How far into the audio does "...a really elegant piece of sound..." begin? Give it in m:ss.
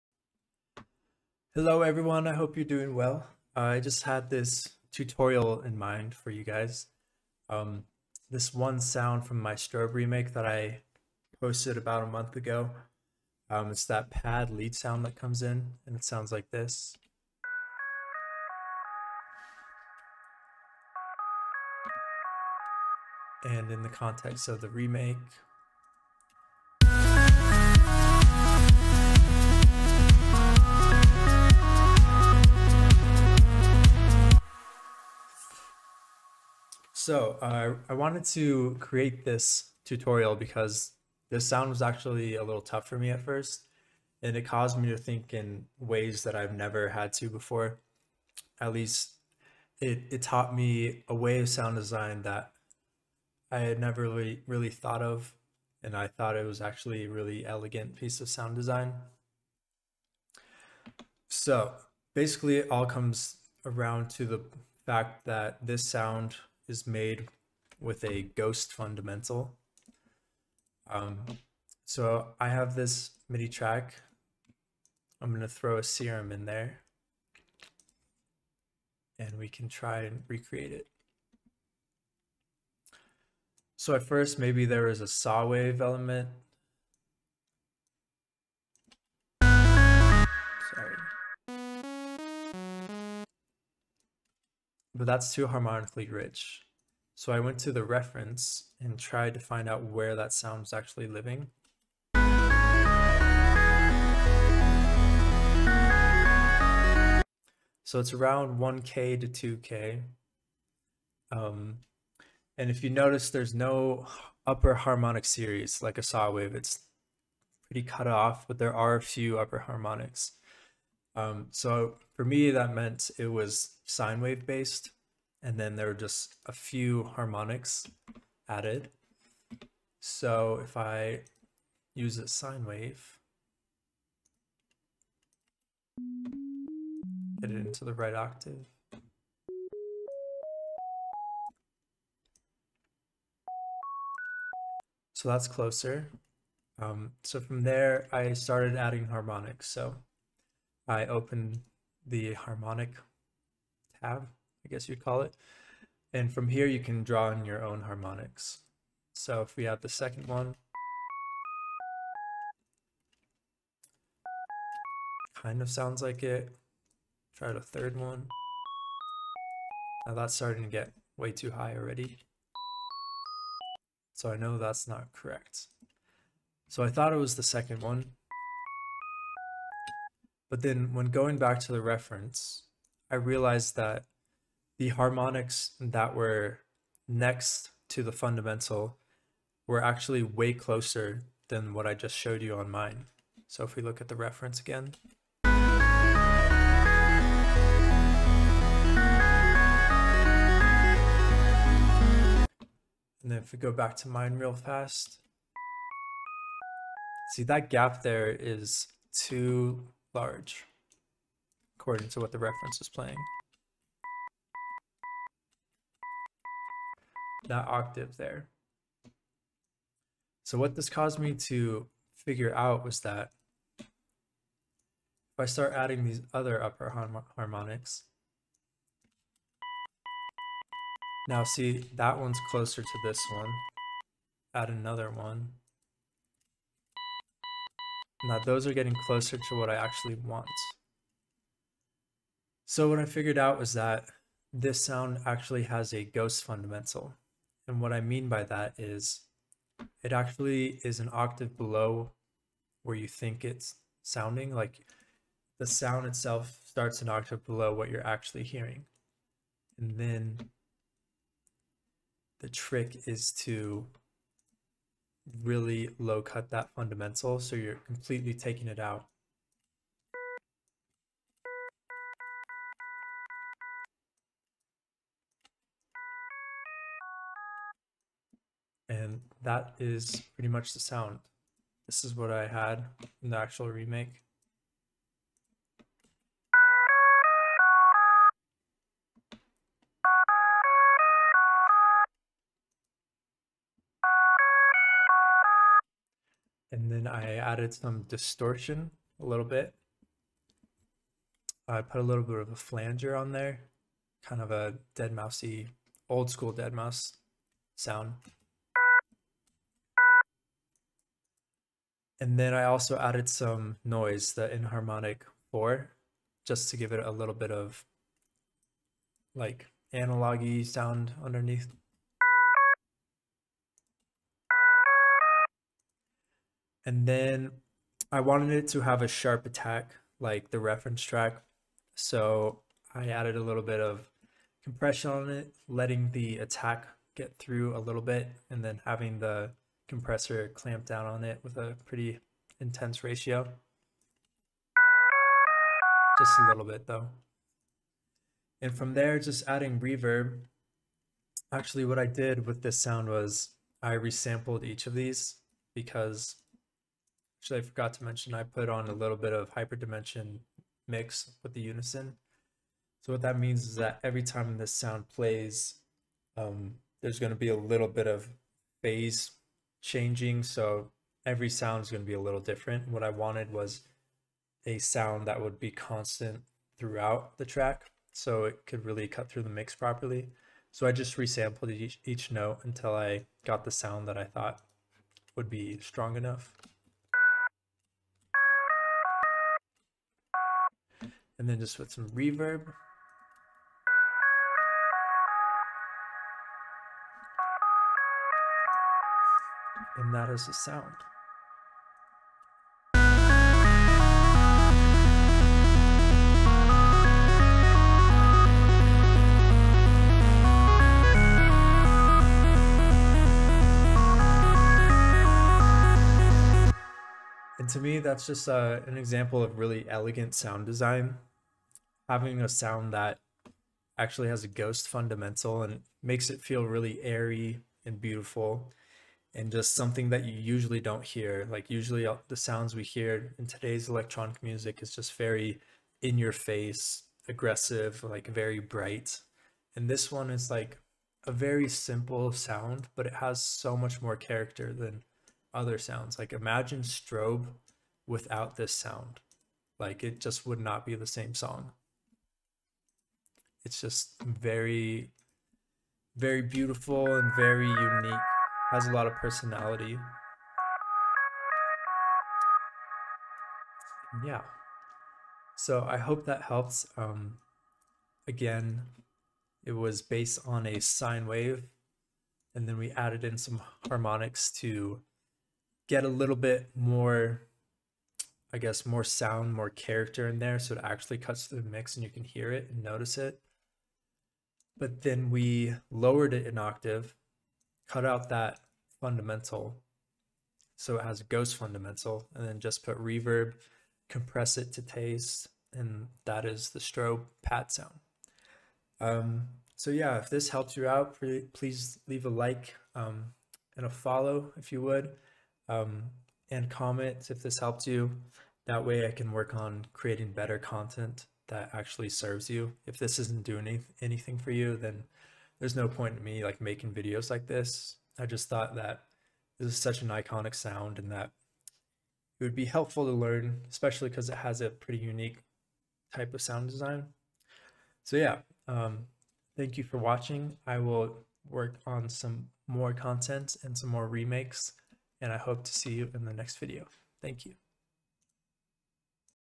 0:57.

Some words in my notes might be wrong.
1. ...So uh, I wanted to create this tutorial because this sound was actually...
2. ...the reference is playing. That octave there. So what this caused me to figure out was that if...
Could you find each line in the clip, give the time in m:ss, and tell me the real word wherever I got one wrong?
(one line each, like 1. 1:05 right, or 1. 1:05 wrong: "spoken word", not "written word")
1. 0:37 right
2. 3:32 right.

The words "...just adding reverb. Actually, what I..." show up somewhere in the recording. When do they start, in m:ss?
5:49.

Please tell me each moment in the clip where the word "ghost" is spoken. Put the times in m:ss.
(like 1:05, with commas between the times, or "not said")
1:08, 4:06, 7:04, 8:11.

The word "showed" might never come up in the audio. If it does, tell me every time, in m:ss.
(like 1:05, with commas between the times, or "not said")
3:12.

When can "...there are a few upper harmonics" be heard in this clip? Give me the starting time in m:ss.
1:58.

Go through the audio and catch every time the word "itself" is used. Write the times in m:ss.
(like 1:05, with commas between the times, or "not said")
4:16.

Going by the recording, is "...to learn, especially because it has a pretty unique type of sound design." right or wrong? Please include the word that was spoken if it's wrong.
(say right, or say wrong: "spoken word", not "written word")
right.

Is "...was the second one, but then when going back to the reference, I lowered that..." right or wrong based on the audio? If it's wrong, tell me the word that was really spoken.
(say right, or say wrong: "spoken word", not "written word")
wrong: "realized", not "lowered".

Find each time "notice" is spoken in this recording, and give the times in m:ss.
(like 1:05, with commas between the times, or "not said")
1:52, 8:02.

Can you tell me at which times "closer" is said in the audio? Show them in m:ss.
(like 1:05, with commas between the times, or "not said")
2:25, 3:10, 3:52, 3:59.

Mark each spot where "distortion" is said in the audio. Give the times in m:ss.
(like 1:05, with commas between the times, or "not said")
4:58.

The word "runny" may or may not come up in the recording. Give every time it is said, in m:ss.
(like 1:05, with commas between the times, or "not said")
not said.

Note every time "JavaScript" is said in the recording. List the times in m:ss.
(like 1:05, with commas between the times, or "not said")
not said.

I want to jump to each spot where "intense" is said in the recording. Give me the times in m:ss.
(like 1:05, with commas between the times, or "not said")
5:42.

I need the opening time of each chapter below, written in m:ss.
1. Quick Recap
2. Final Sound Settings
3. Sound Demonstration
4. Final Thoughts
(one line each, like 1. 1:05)
1. 7:48
2. 4:45
3. 0:16
4. 6:58.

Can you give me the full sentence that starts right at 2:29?
So I open the harmonic tab, I guess you'd call it.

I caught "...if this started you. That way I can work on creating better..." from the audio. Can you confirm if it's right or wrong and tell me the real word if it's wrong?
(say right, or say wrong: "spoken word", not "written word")
wrong: "helped", not "started".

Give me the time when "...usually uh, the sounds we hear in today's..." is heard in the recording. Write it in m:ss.
7:11.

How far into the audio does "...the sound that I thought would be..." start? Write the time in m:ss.
6:23.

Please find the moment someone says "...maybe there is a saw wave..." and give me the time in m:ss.
1:24.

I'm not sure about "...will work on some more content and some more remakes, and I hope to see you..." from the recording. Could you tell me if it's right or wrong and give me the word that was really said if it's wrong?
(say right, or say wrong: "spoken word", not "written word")
right.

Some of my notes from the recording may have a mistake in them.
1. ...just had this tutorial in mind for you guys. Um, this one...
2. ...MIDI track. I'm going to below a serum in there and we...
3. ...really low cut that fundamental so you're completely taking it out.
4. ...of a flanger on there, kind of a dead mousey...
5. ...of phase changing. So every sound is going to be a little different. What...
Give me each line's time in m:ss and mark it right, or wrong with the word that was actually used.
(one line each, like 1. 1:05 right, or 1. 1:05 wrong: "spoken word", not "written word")
1. 0:03 right
2. 1:13 wrong: "throw", not "below"
3. 4:25 right
4. 5:02 right
5. 6:08 right.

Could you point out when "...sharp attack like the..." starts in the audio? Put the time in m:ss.
5:29.